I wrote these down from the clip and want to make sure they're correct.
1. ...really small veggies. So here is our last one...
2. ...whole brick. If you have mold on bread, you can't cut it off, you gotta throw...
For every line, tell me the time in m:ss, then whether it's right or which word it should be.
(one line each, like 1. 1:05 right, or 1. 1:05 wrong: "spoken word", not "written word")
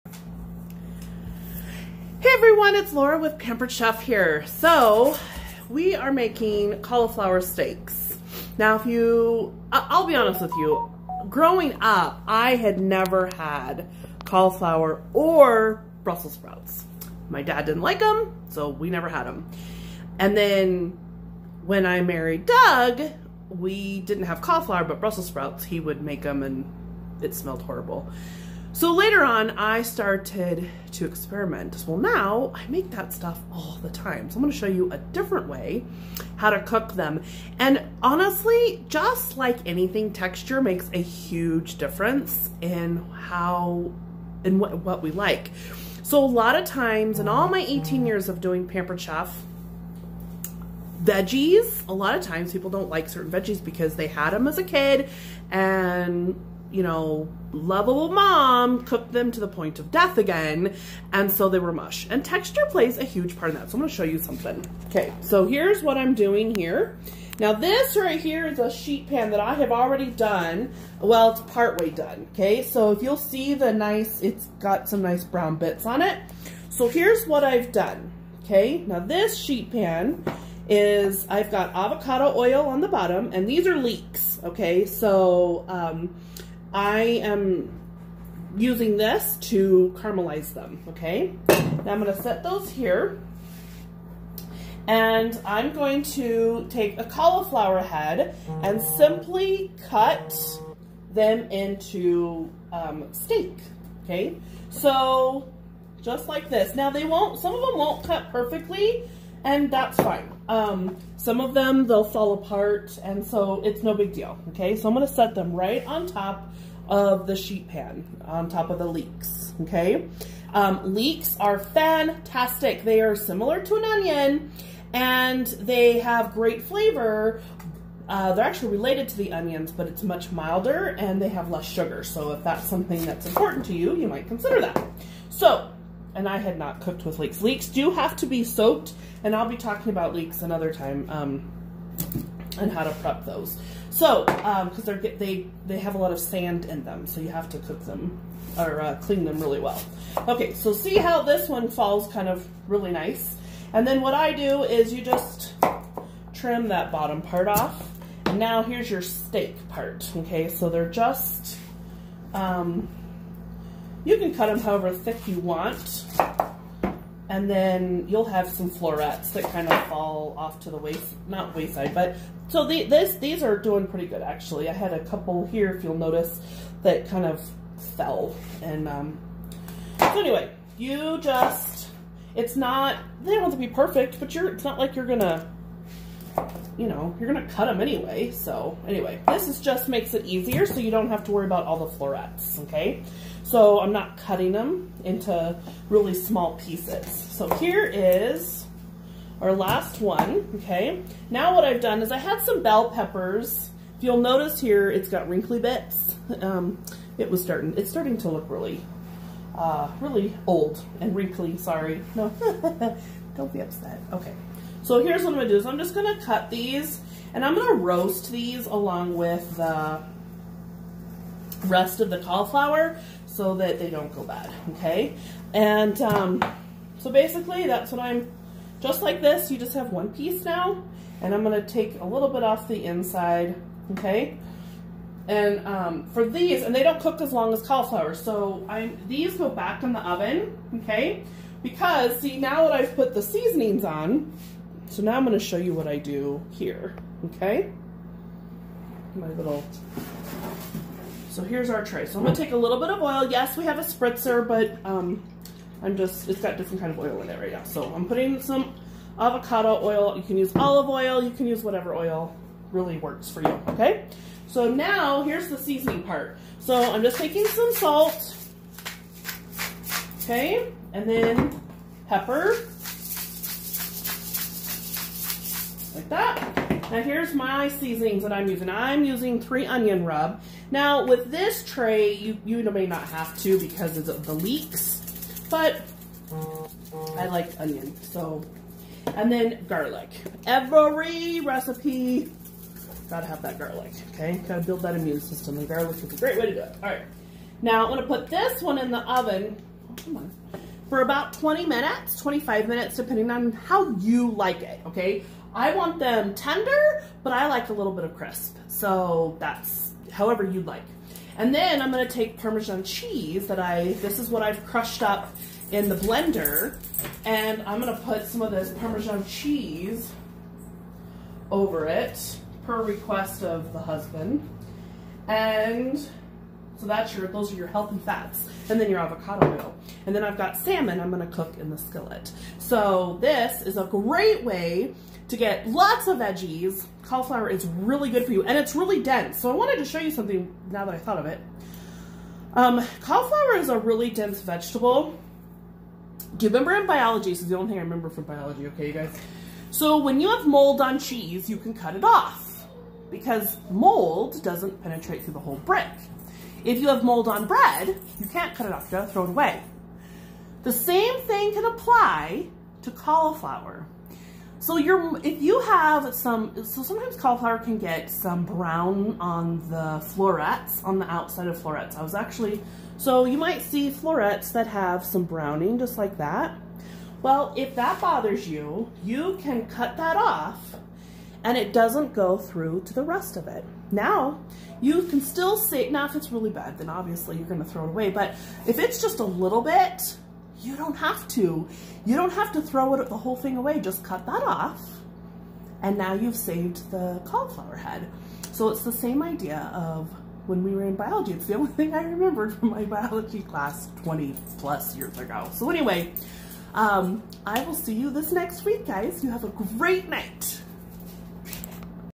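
1. 3:15 wrong: "pieces", not "veggies"
2. 5:55 right.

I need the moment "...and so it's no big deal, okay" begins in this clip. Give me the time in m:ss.
1:53.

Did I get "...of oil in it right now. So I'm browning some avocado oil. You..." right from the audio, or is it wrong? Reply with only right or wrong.
wrong.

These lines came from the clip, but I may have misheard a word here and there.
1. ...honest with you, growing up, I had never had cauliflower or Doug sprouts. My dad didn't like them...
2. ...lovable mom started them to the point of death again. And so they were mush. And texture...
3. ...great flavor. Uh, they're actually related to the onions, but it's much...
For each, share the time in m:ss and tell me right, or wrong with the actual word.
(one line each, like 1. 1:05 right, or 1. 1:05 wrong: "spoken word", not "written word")
1. 0:10 wrong: "Brussels", not "Doug"
2. 0:57 wrong: "cooked", not "started"
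3. 2:06 right.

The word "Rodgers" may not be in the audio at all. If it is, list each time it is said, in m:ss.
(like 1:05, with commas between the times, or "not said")
not said.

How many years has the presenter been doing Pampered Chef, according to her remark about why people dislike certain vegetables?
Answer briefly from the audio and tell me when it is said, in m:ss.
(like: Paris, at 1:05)
18, at 0:47.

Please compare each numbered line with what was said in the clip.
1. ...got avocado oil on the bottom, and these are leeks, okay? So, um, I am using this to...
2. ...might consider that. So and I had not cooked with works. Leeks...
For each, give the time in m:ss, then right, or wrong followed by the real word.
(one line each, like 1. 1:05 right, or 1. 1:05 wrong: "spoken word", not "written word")
1. 1:21 right
2. 2:14 wrong: "leeks", not "works".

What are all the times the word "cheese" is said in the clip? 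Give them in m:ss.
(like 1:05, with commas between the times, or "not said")
5:12, 5:19, 5:50.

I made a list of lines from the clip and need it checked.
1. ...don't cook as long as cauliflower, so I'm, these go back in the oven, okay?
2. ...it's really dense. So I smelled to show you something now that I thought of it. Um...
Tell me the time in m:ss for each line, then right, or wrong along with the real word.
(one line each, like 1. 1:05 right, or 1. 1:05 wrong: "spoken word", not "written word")
1. 3:56 right
2. 5:38 wrong: "wanted", not "smelled".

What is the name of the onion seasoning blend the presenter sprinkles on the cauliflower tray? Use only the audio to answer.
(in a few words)
Three onion rub.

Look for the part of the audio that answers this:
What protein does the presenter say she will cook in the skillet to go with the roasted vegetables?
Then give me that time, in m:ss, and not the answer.
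5:30.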